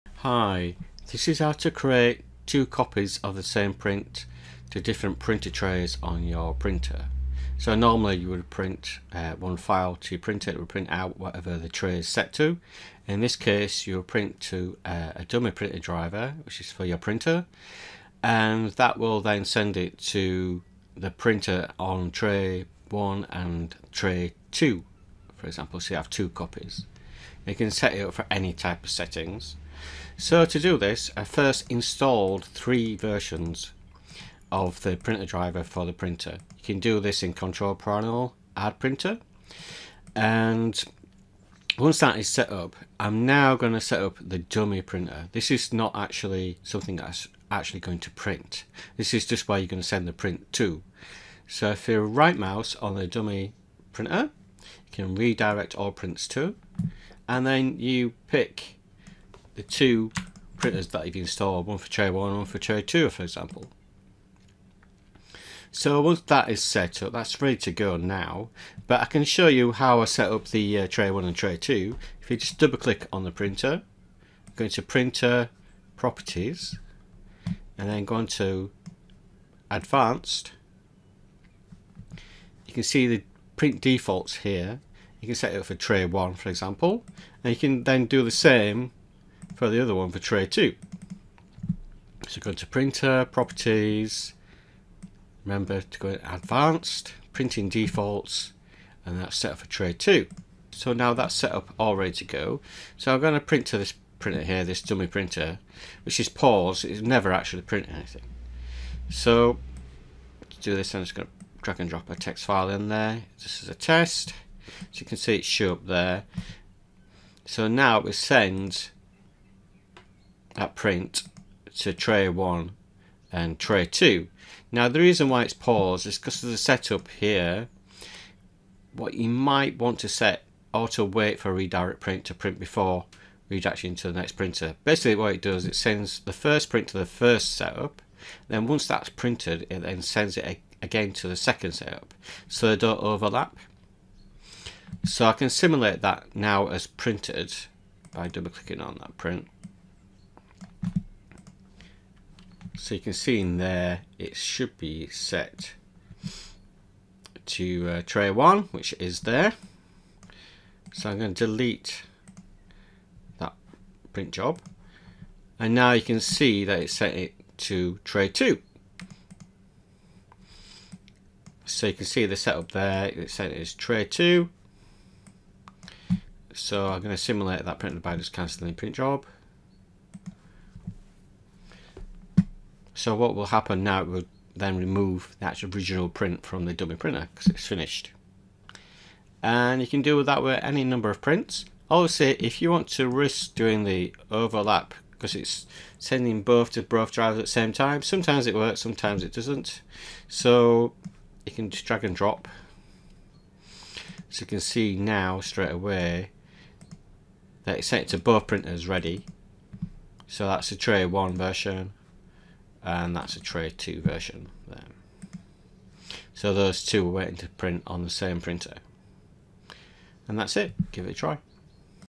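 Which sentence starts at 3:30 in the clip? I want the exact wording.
So that's the tray one version and that's a tray 2 version there.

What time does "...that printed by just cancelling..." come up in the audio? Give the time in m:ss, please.
2:57.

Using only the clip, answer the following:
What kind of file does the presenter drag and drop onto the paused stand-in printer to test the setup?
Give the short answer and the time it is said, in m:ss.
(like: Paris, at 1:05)
Text file, at 1:52.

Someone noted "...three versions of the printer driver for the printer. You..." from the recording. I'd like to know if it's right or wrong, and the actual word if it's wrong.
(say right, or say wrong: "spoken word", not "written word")
right.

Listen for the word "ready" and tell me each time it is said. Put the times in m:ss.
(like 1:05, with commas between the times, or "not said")
1:07, 1:41, 3:28.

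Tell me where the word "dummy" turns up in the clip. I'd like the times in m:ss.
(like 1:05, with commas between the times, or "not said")
0:15, 0:44, 0:53, 1:44, 3:06.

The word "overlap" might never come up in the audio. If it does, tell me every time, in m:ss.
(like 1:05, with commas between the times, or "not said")
2:23, 3:14.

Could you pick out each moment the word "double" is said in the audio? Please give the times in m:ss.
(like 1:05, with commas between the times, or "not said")
1:12, 2:28.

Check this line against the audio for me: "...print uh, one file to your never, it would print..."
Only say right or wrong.
wrong.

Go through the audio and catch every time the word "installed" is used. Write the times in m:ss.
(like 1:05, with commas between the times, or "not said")
0:31, 1:01.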